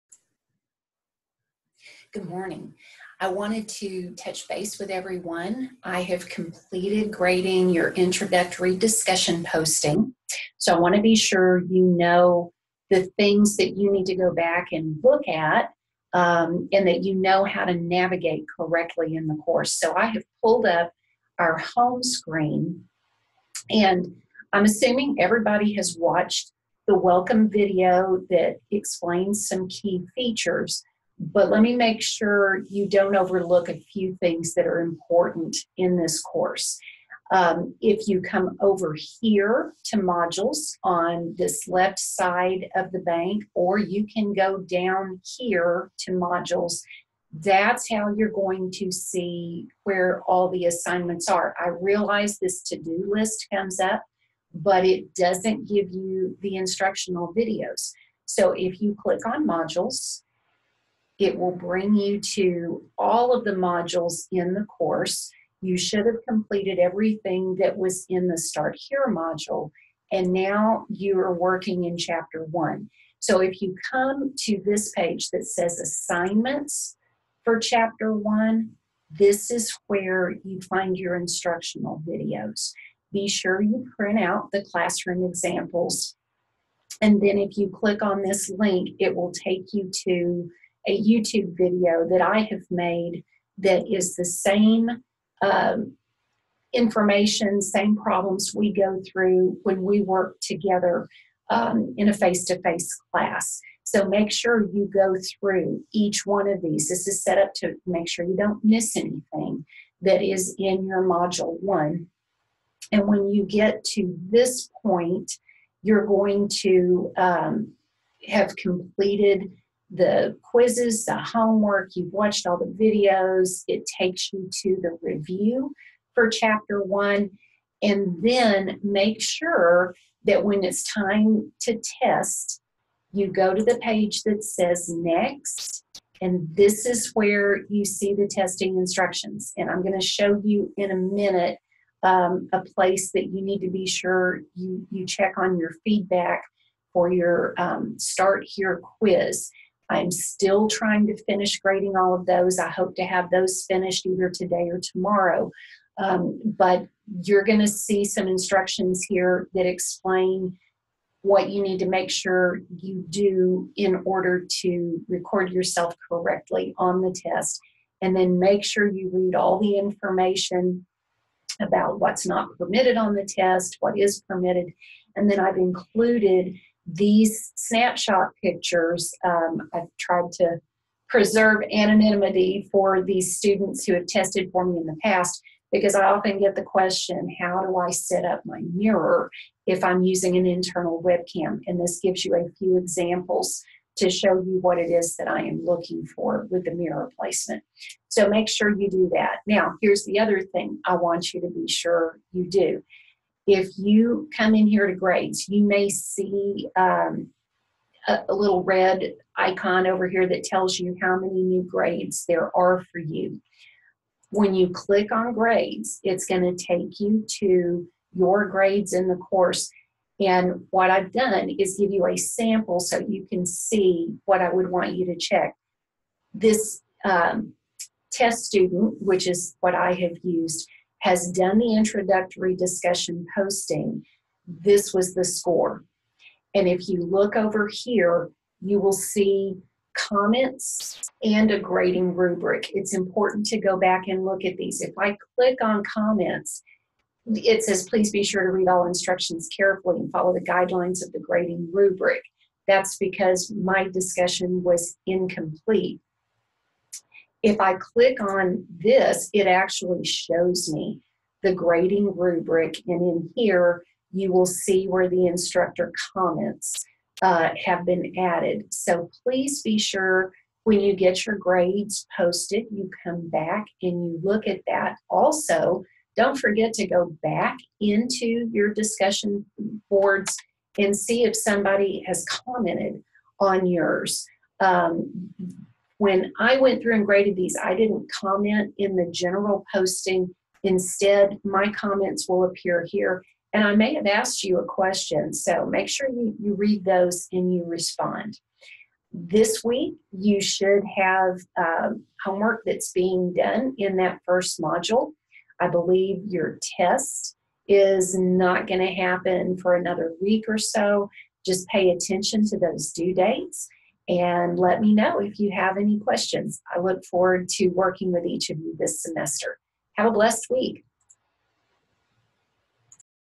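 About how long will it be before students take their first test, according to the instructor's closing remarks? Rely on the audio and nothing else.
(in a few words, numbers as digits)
another week.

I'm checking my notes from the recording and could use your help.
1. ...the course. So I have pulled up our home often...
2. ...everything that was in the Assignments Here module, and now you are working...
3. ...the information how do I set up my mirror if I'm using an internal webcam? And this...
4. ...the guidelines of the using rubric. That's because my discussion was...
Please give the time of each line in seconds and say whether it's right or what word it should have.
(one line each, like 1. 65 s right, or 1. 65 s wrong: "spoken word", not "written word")
1. 19 s wrong: "screen", not "often"
2. 66 s wrong: "Start", not "Assignments"
3. 186 s wrong: "question", not "information"
4. 250 s wrong: "grading", not "using".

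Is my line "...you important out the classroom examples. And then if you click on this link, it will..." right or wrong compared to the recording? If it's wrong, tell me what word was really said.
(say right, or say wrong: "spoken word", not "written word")
wrong: "print", not "important".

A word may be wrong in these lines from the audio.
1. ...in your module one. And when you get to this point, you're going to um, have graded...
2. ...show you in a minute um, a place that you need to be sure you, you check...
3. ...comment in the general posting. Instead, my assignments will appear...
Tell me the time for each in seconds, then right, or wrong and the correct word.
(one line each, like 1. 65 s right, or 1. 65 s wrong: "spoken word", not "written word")
1. 110 s wrong: "completed", not "graded"
2. 140 s right
3. 288 s wrong: "comments", not "assignments".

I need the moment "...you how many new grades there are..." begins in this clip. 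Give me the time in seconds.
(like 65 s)
210 s.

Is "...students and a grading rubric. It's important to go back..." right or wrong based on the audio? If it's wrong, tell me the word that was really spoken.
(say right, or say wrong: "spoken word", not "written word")
wrong: "comments", not "students".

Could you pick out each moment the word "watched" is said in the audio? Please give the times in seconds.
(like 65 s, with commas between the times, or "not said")
25 s, 122 s.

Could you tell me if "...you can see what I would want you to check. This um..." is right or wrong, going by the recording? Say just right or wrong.
right.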